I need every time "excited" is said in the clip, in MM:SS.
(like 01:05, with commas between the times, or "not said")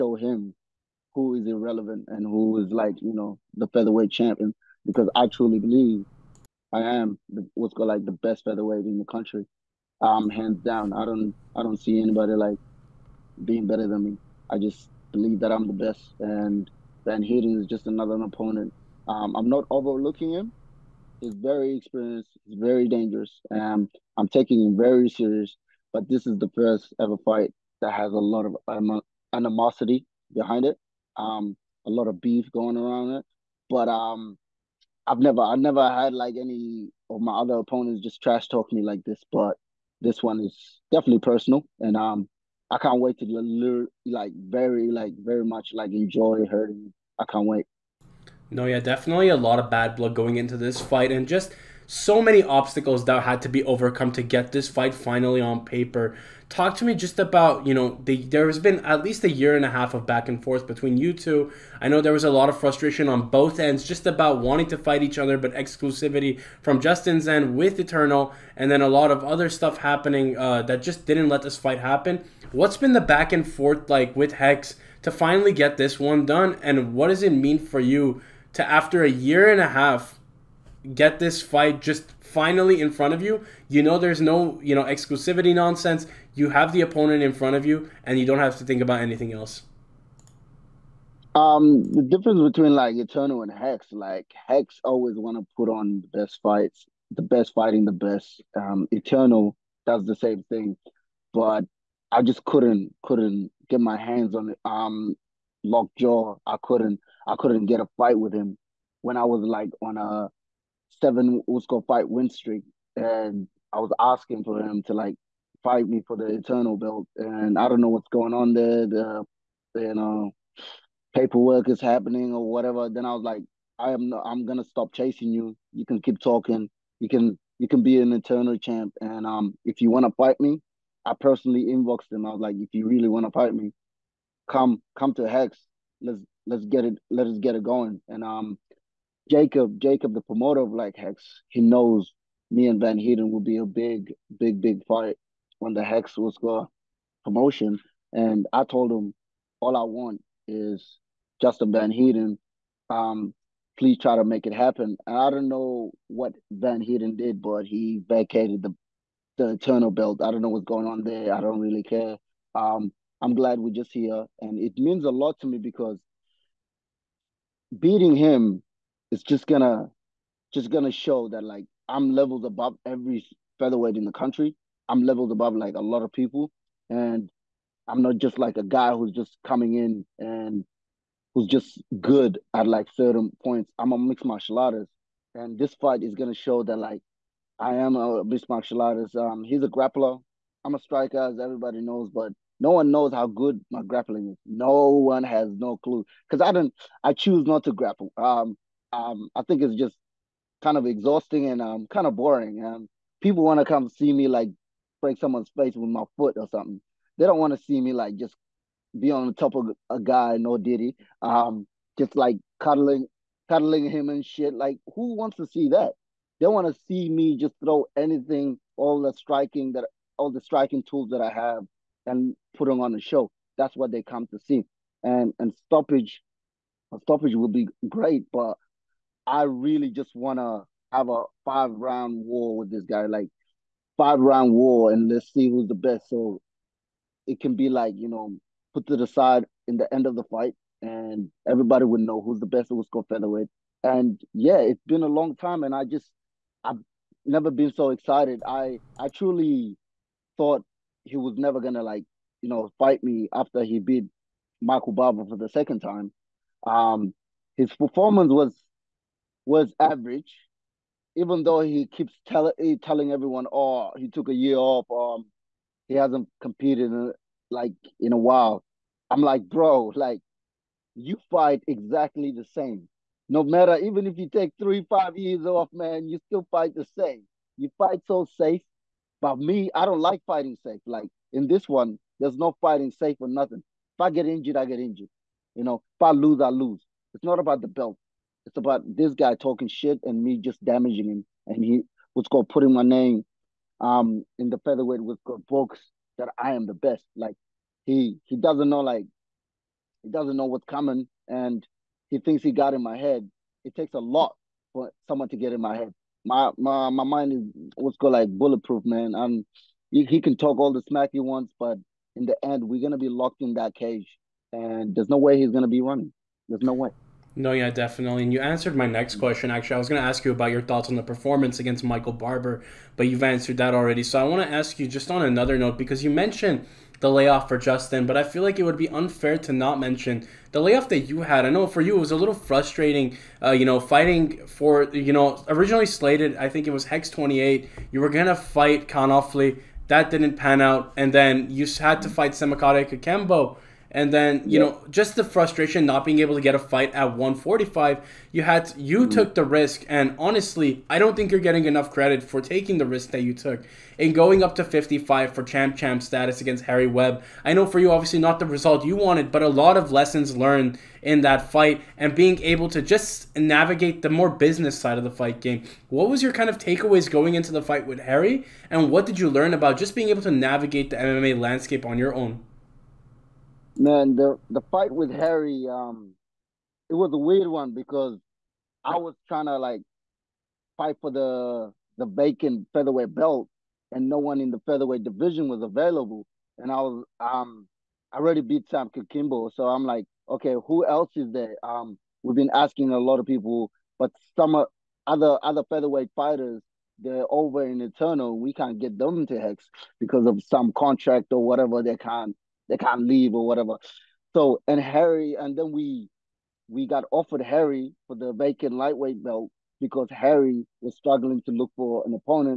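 04:07.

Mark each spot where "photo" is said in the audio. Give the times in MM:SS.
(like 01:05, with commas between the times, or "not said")
not said.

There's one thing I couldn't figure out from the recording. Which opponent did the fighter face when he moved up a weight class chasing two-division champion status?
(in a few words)
Harry Webb.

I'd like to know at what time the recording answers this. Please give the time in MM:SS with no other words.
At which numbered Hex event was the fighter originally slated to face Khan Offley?
05:36.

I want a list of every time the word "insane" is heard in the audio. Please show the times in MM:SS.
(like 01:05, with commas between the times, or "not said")
not said.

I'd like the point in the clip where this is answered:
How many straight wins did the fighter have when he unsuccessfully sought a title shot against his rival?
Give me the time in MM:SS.
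01:51.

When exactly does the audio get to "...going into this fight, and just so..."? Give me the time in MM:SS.
00:50.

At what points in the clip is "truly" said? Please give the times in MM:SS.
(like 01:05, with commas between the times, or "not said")
00:05, 04:09.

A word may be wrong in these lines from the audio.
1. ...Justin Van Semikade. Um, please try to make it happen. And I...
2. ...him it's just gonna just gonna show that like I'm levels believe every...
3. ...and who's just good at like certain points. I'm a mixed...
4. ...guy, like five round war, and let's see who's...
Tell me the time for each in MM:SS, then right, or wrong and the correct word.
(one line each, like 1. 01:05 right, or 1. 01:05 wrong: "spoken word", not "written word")
1. 02:31 wrong: "Heerden", not "Semikade"
2. 02:48 wrong: "above", not "believe"
3. 03:00 right
4. 03:52 right.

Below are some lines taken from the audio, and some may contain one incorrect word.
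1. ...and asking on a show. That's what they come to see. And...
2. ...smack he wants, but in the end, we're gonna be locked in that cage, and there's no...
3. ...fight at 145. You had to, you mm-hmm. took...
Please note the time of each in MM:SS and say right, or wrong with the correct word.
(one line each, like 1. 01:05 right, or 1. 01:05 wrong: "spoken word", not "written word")
1. 03:42 wrong: "putting", not "asking"
2. 05:10 right
3. 05:46 right.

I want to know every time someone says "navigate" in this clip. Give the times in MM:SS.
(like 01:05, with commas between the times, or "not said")
06:03, 06:10.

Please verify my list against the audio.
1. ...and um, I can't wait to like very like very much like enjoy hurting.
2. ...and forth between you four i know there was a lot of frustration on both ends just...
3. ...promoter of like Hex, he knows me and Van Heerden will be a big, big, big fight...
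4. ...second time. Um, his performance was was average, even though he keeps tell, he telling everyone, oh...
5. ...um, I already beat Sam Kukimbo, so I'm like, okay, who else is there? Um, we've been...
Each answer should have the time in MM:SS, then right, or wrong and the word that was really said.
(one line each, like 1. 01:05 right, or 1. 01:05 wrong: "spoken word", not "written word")
1. 00:41 right
2. 01:00 wrong: "two", not "four"
3. 02:20 right
4. 04:15 right
5. 06:27 right.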